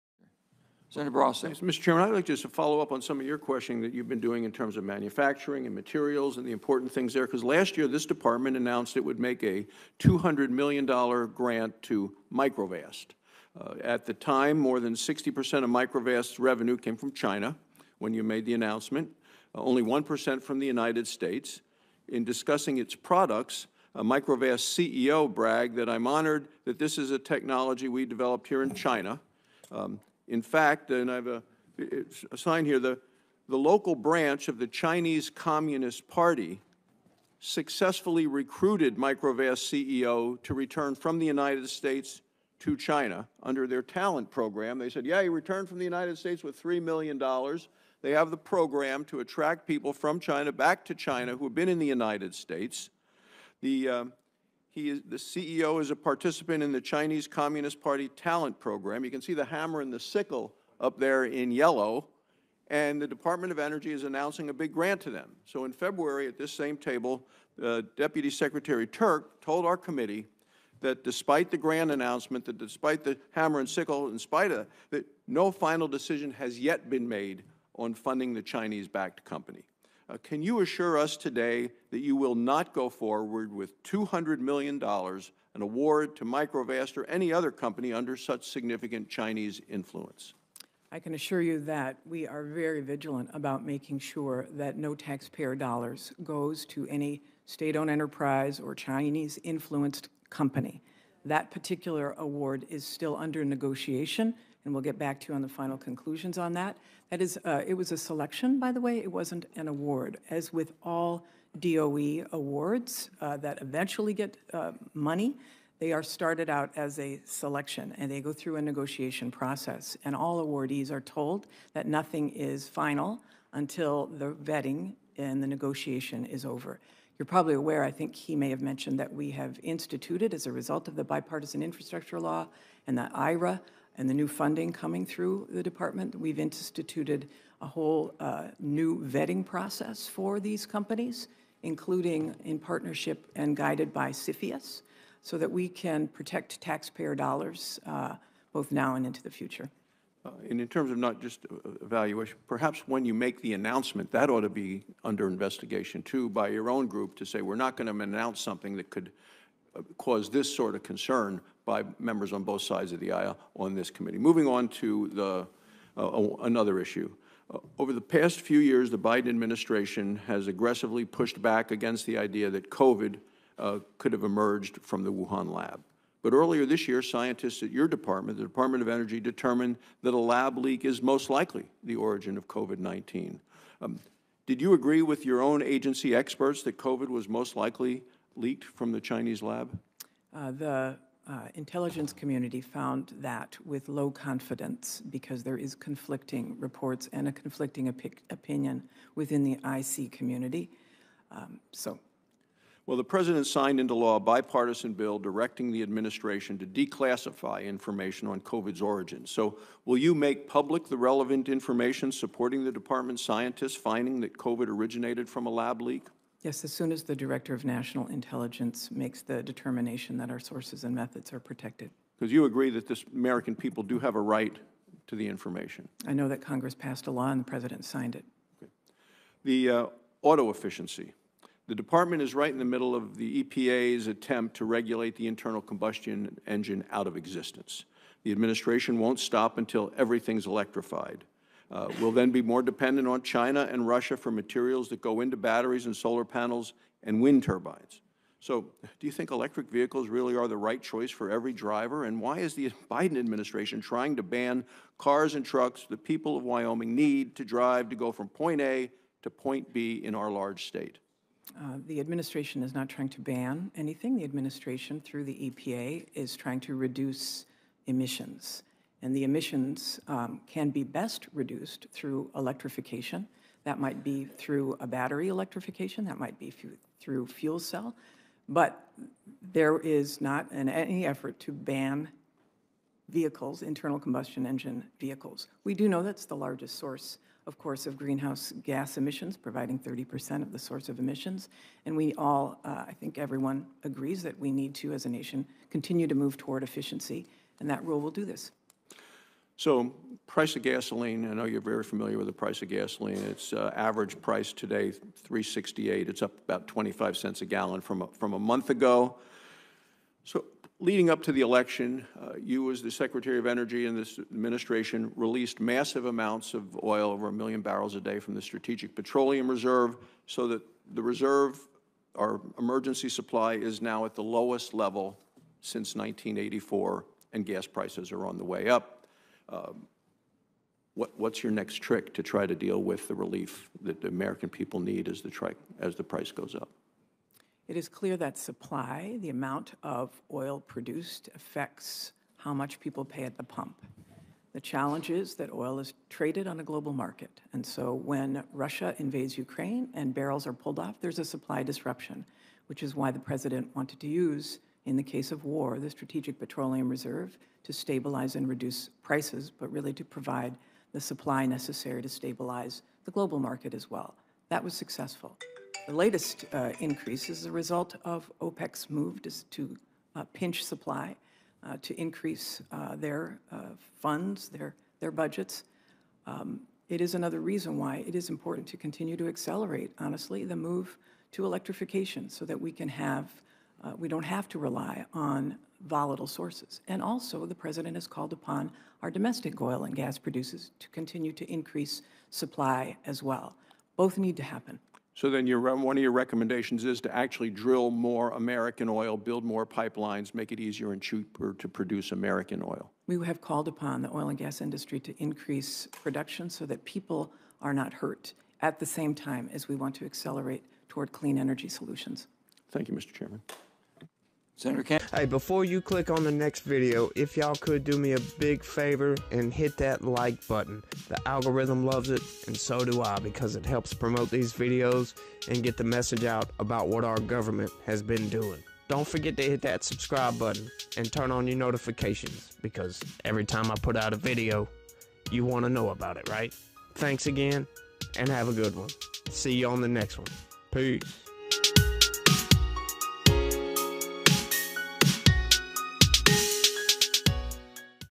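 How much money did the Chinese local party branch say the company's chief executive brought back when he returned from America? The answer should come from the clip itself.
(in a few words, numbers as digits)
$3 million.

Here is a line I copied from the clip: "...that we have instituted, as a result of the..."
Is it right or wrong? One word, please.
right.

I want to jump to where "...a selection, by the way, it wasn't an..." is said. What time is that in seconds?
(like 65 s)
107 s.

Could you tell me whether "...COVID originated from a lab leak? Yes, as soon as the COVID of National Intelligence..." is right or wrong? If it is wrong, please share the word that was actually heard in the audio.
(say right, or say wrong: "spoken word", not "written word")
wrong: "Director", not "COVID".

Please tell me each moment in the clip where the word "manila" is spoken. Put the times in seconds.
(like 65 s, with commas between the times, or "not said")
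not said.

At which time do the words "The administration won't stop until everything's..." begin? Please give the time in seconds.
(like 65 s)
238 s.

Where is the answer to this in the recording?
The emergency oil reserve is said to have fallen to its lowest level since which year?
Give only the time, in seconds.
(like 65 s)
325 s.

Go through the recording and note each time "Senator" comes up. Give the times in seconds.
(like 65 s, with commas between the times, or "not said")
0 s, 414 s.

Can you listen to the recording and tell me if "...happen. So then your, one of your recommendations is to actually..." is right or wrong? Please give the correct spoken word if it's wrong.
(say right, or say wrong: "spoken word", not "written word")
right.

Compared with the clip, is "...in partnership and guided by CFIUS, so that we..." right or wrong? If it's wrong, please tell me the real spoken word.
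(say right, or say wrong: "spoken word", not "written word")
right.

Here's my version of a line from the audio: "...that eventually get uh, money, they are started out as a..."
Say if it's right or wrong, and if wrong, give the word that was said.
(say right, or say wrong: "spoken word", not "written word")
right.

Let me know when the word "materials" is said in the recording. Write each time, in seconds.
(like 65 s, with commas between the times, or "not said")
5 s, 244 s.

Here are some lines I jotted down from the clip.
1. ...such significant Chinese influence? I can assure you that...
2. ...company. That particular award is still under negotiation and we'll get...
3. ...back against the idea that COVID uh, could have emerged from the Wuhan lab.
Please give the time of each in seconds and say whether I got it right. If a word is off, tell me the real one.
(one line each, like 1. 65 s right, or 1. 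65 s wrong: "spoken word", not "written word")
1. 88 s right
2. 100 s right
3. 171 s right.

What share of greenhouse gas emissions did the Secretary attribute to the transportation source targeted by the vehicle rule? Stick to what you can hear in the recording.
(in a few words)
30%.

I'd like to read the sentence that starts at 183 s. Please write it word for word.
Um, did you agree with your own agency experts that COVID was most likely leaked from the Chinese lab?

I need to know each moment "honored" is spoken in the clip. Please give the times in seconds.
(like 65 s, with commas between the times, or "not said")
26 s.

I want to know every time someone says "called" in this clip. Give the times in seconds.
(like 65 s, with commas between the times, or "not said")
388 s, 403 s.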